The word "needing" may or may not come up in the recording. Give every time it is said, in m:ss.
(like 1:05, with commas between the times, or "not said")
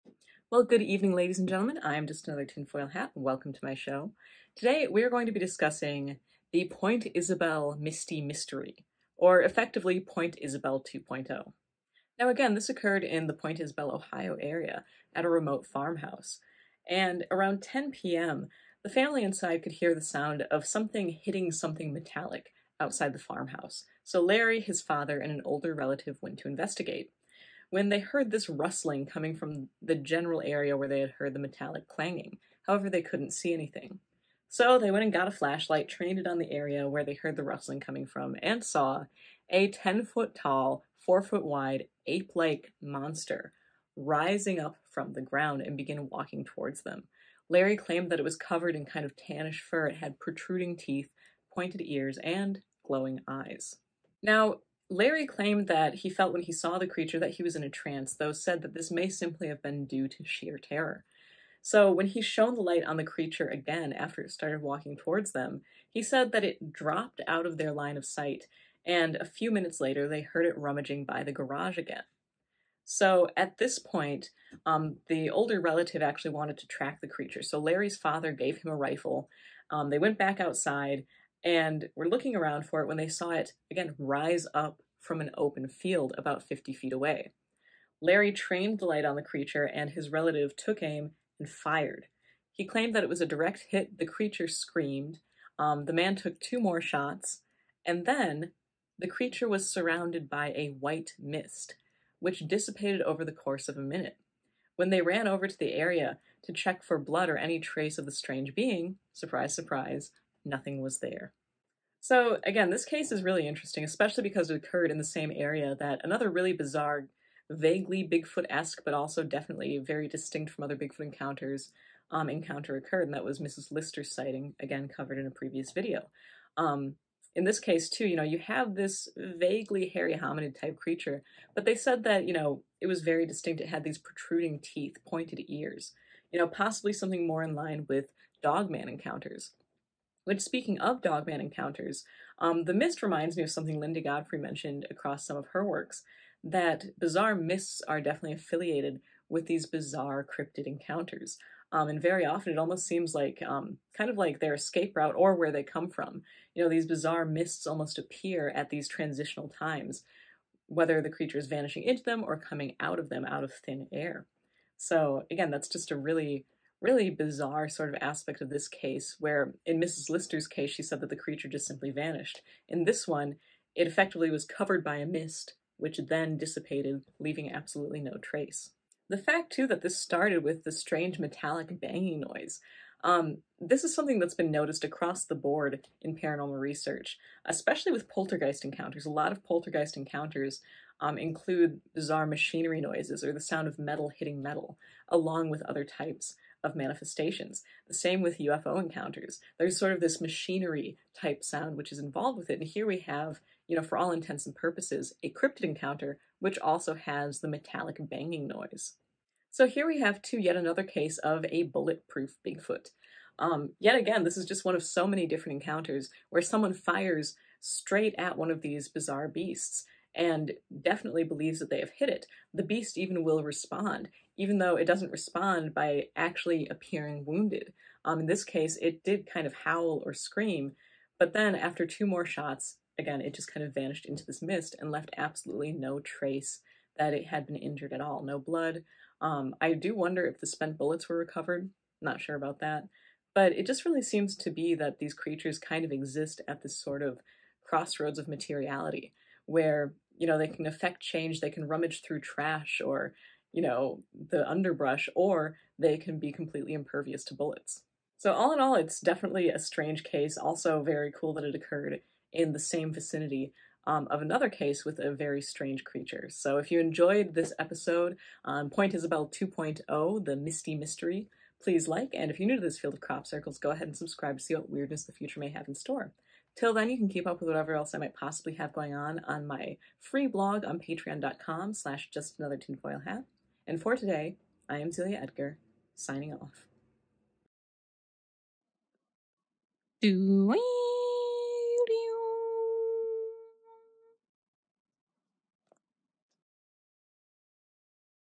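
not said.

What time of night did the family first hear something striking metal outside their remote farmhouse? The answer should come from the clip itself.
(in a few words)
10 p.m.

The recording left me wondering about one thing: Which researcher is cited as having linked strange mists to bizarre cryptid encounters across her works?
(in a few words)
Linda Godfrey.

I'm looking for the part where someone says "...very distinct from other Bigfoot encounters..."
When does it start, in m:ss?
1:59.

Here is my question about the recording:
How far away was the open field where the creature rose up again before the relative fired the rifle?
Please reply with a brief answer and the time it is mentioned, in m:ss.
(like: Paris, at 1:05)
50 feet, at 1:26.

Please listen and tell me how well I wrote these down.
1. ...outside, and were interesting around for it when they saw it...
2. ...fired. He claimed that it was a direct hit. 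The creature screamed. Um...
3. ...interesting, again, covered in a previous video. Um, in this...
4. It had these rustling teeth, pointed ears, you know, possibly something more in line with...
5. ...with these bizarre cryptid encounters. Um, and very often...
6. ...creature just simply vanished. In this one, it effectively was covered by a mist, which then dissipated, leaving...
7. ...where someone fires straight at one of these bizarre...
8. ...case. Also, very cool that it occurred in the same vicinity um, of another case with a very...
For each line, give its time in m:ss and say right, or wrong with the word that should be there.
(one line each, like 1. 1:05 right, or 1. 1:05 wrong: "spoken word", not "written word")
1. 1:20 wrong: "looking", not "interesting"
2. 1:31 right
3. 2:04 wrong: "sighting", not "interesting"
4. 2:13 wrong: "protruding", not "rustling"
5. 2:29 right
6. 2:51 right
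7. 3:36 right
8. 4:20 right.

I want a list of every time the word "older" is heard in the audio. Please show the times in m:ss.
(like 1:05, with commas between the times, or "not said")
0:25, 1:15.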